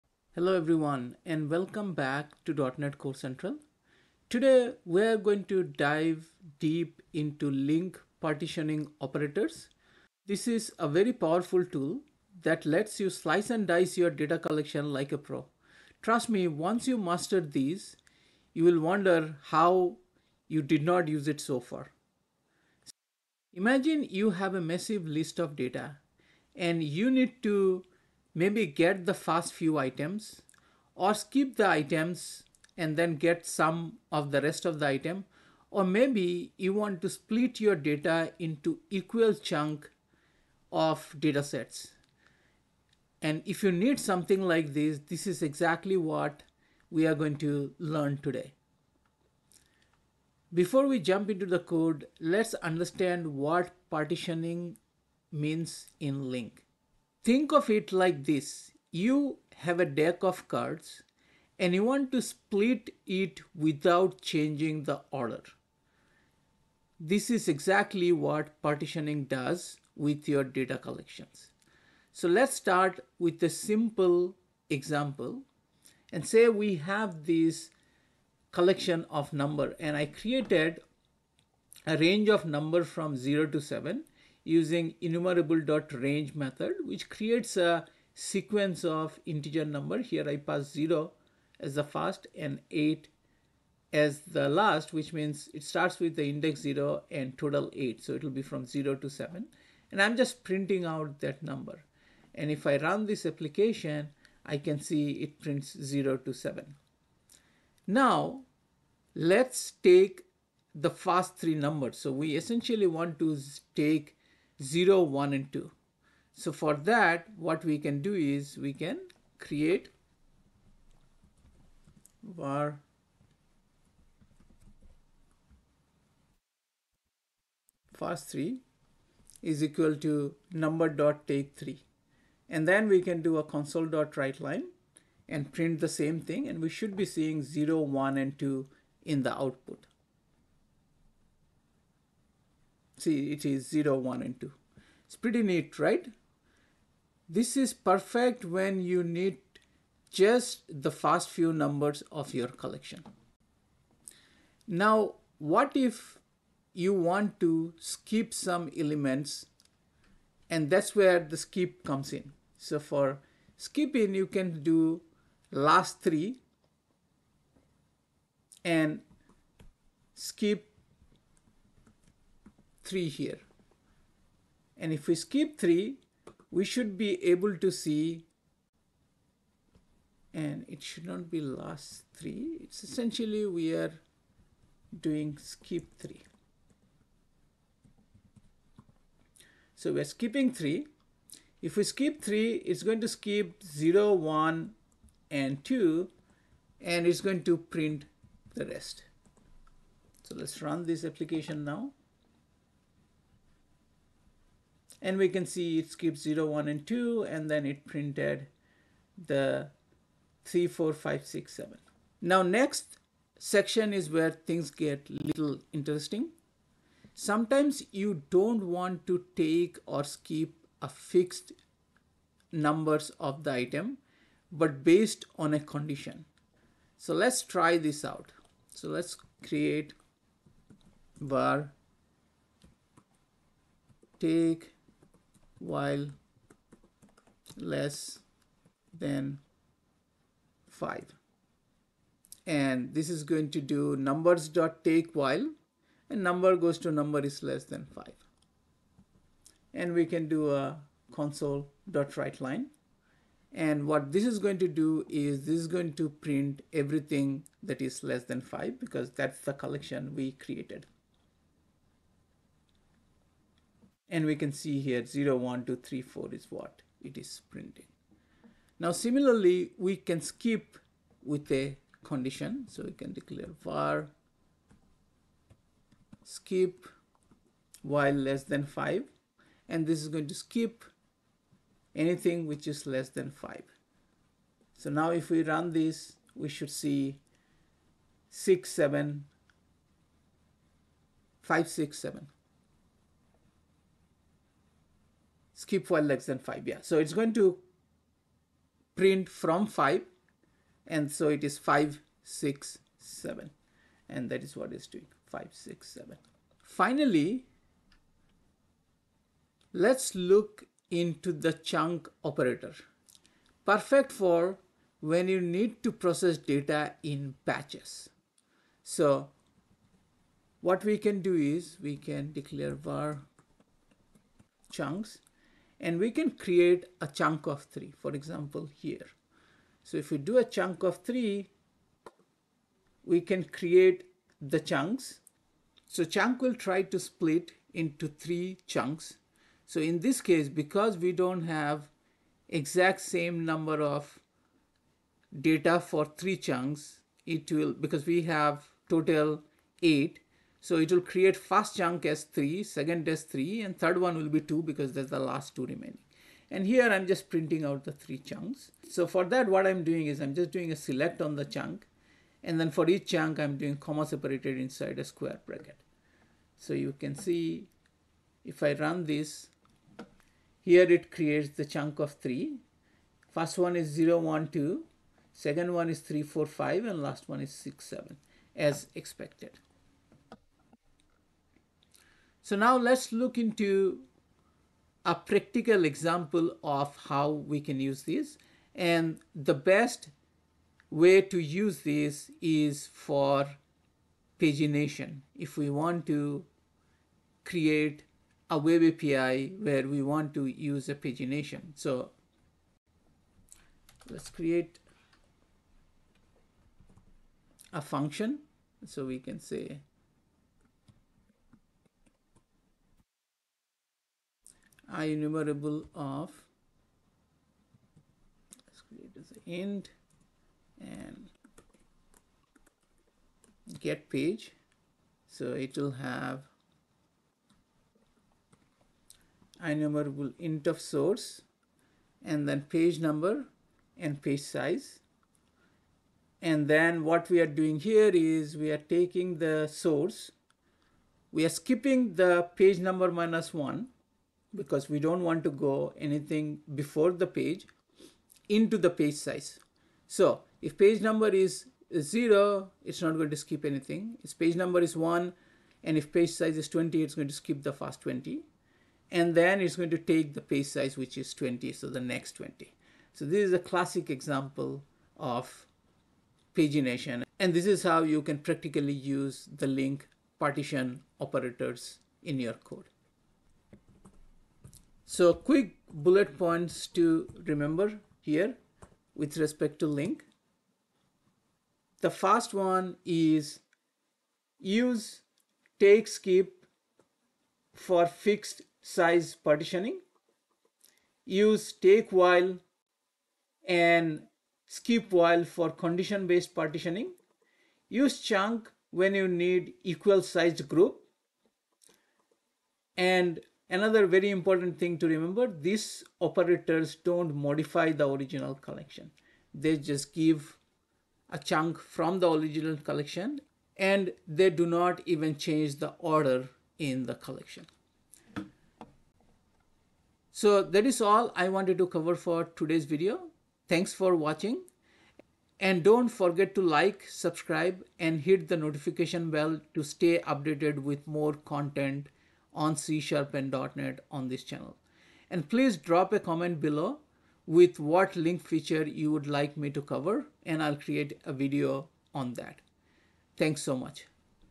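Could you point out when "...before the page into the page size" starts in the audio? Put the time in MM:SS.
07:26.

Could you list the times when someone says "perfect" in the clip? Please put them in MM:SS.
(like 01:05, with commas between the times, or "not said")
02:27, 05:13.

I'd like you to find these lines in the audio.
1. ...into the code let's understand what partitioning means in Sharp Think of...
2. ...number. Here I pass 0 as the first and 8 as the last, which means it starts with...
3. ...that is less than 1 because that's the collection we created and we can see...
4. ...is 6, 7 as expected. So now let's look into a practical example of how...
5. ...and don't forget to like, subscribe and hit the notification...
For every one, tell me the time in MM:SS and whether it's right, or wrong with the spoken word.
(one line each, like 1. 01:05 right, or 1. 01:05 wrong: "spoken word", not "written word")
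1. 00:51 wrong: "LINQ", not "Sharp"
2. 01:29 right
3. 04:17 wrong: "5", not "1"
4. 06:17 right
5. 08:45 right.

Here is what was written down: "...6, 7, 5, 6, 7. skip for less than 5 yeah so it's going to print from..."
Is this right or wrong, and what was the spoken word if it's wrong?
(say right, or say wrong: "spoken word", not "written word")
right.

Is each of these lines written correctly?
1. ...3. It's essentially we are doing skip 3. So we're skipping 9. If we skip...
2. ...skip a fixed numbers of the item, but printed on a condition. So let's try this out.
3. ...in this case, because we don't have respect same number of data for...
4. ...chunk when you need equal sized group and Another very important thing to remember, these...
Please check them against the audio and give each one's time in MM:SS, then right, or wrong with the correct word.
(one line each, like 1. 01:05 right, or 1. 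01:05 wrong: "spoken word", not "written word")
1. 03:02 wrong: "3", not "9"
2. 03:40 wrong: "based", not "printed"
3. 05:39 wrong: "exact", not "respect"
4. 08:18 right.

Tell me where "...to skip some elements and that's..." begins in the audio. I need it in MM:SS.
02:37.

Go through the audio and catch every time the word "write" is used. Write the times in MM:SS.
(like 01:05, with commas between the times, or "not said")
02:14, 04:12.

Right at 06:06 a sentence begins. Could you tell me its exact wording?
So you can see if I run this, here it creates the chunk of 3.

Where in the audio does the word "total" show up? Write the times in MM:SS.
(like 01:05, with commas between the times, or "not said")
01:37, 05:48.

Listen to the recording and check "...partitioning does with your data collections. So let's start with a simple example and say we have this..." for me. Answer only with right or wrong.
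right.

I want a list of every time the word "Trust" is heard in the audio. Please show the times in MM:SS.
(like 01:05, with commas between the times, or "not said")
00:16.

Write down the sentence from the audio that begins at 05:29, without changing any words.
So if we do a chunk of three, we can create the chunks.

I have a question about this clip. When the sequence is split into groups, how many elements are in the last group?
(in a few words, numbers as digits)
2.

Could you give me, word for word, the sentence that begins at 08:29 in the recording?
They just give a chunk from the original collection and they do not even change the order in the collection.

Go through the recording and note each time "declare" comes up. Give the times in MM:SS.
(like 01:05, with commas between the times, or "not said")
04:33, 05:22.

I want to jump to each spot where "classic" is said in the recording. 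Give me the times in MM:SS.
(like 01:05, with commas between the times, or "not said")
07:43.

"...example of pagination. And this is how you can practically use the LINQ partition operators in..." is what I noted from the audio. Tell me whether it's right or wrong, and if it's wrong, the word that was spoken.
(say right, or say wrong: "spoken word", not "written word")
right.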